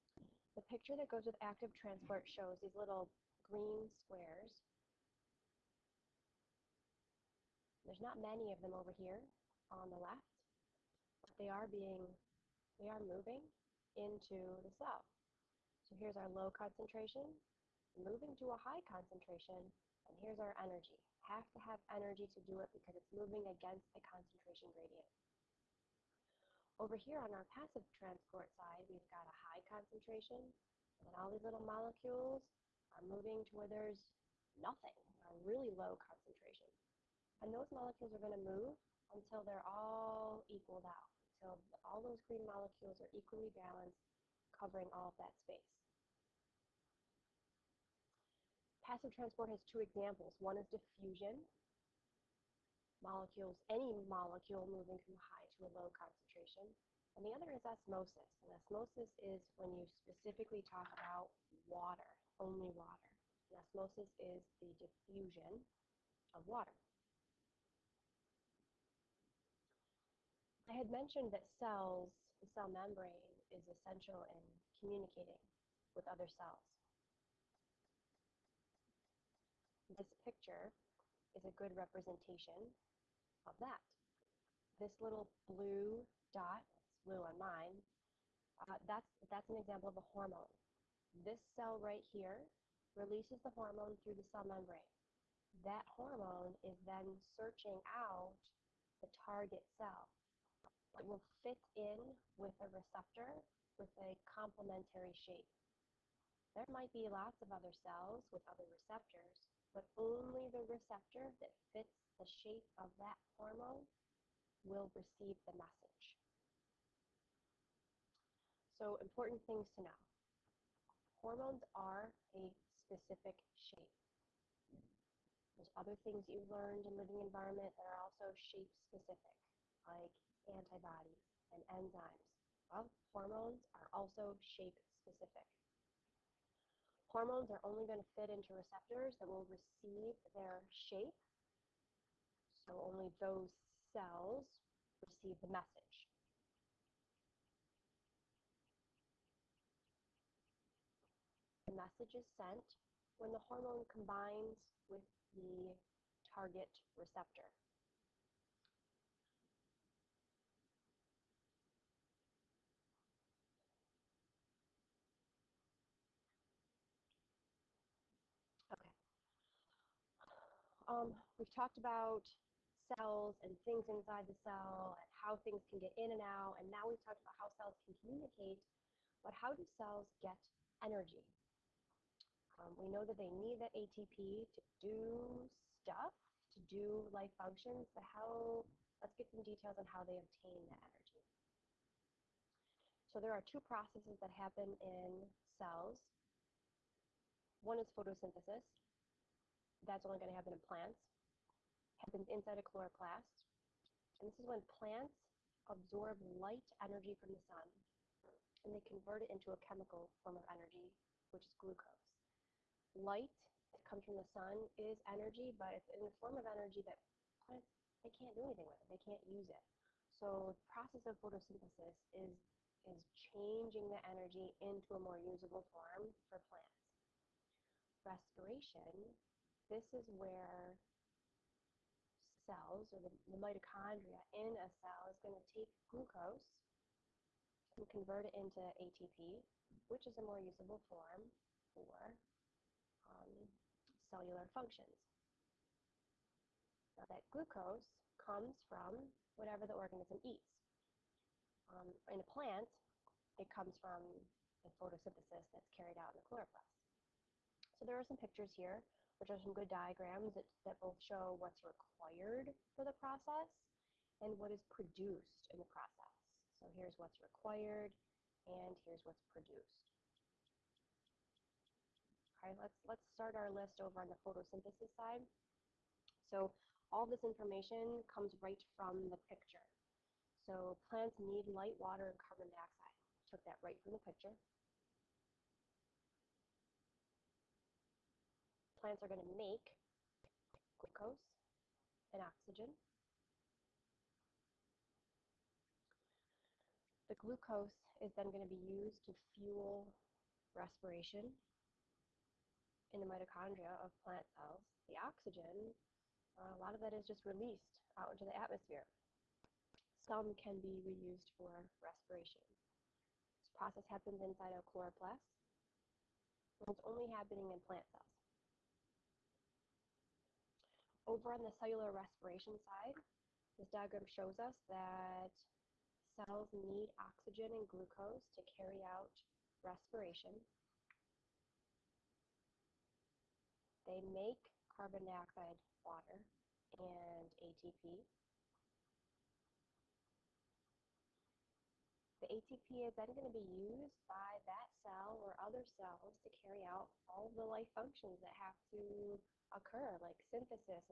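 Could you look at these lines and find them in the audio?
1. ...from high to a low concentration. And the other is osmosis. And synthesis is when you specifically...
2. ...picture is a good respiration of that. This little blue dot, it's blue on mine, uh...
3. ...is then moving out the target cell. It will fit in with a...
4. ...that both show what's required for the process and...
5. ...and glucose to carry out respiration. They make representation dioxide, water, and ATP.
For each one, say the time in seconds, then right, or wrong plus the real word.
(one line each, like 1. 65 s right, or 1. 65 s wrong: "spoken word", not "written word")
1. 55 s wrong: "osmosis", not "synthesis"
2. 80 s wrong: "representation", not "respiration"
3. 96 s wrong: "searching", not "moving"
4. 260 s right
5. 327 s wrong: "carbon", not "representation".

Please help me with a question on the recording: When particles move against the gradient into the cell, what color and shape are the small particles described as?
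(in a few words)
green squares.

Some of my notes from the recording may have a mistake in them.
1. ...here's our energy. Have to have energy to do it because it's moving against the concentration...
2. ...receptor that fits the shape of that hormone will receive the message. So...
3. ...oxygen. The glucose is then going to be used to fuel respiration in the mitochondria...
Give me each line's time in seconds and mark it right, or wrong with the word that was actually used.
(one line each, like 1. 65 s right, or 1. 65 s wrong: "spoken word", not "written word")
1. 20 s right
2. 110 s right
3. 292 s right.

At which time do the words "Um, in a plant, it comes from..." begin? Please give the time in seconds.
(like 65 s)
251 s.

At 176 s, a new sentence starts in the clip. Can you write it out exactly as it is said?
And now we've talked about how cells can communicate, but how do cells get energy?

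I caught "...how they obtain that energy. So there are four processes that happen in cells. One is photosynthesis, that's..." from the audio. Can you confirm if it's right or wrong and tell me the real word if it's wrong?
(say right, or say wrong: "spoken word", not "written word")
wrong: "two", not "four".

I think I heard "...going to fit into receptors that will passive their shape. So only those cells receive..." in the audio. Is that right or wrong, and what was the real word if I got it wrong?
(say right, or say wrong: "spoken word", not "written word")
wrong: "receive", not "passive".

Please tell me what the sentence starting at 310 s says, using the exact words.
Some can be reused for respiration.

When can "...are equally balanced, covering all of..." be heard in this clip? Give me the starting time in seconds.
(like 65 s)
42 s.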